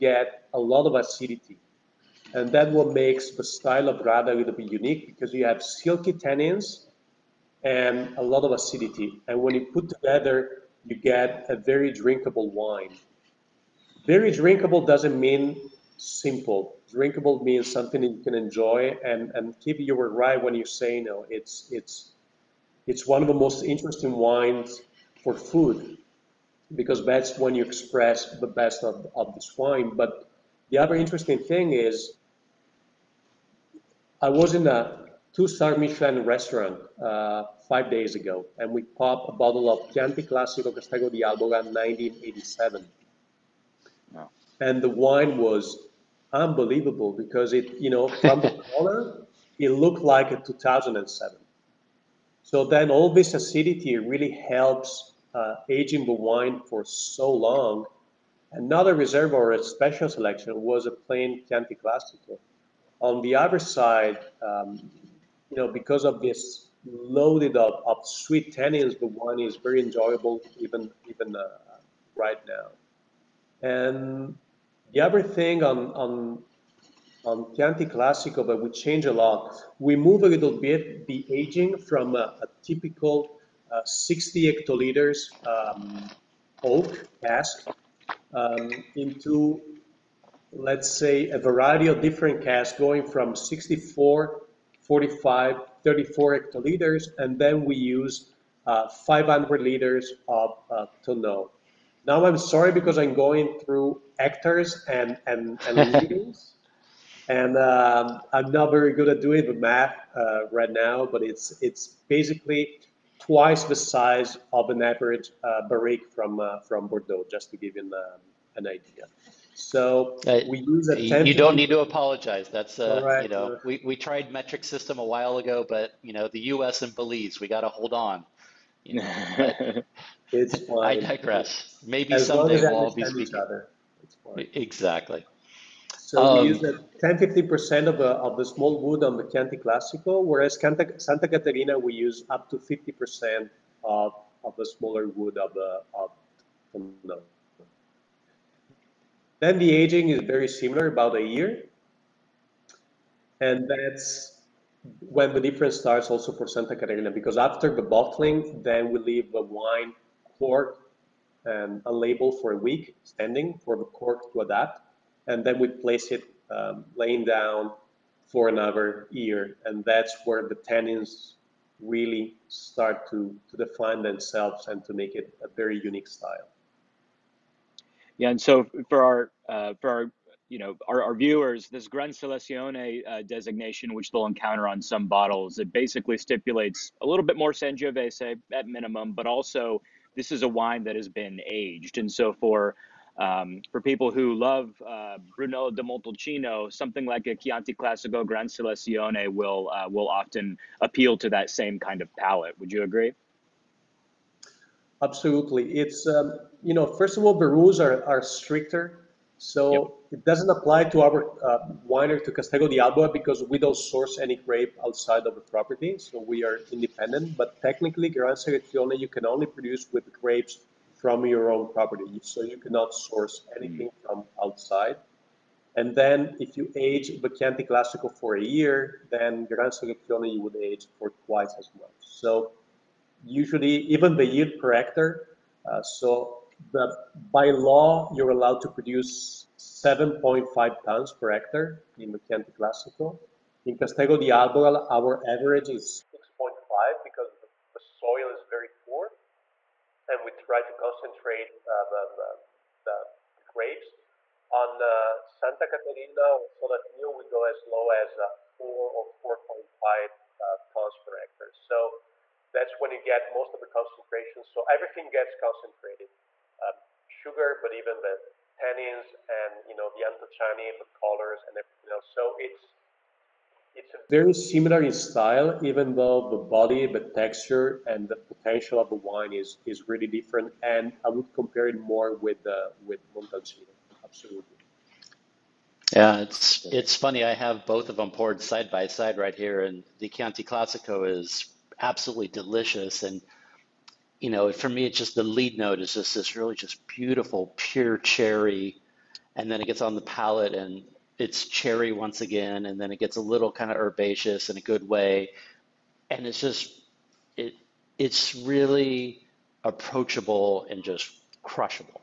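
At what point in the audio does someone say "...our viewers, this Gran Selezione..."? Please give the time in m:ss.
3:01.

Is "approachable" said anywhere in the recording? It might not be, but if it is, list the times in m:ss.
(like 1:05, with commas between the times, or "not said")
5:09.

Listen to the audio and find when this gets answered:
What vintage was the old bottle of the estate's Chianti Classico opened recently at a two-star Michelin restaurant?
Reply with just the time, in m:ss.
0:41.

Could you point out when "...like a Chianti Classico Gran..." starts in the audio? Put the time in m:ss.
3:17.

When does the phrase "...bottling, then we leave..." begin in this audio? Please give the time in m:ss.
2:37.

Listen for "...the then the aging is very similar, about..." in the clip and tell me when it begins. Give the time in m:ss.
2:26.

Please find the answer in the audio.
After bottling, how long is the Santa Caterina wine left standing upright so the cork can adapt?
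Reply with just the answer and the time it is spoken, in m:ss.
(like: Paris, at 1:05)
a week, at 2:42.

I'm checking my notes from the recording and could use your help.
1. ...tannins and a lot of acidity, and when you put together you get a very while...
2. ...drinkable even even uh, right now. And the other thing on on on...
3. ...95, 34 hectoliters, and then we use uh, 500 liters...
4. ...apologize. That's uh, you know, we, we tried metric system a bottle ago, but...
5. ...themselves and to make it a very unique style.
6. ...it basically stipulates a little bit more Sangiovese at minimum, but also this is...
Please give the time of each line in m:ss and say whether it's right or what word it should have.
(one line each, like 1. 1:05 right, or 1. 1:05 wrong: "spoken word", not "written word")
1. 0:06 wrong: "drinkable", not "while"
2. 1:09 wrong: "enjoyable", not "drinkable"
3. 1:34 wrong: "45", not "95"
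4. 2:01 wrong: "while", not "bottle"
5. 2:54 right
6. 3:05 right.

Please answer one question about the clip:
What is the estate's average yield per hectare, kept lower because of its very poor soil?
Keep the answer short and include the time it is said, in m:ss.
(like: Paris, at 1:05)
6.5, at 4:06.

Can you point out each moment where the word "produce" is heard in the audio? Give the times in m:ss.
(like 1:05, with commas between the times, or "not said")
3:39, 3:58.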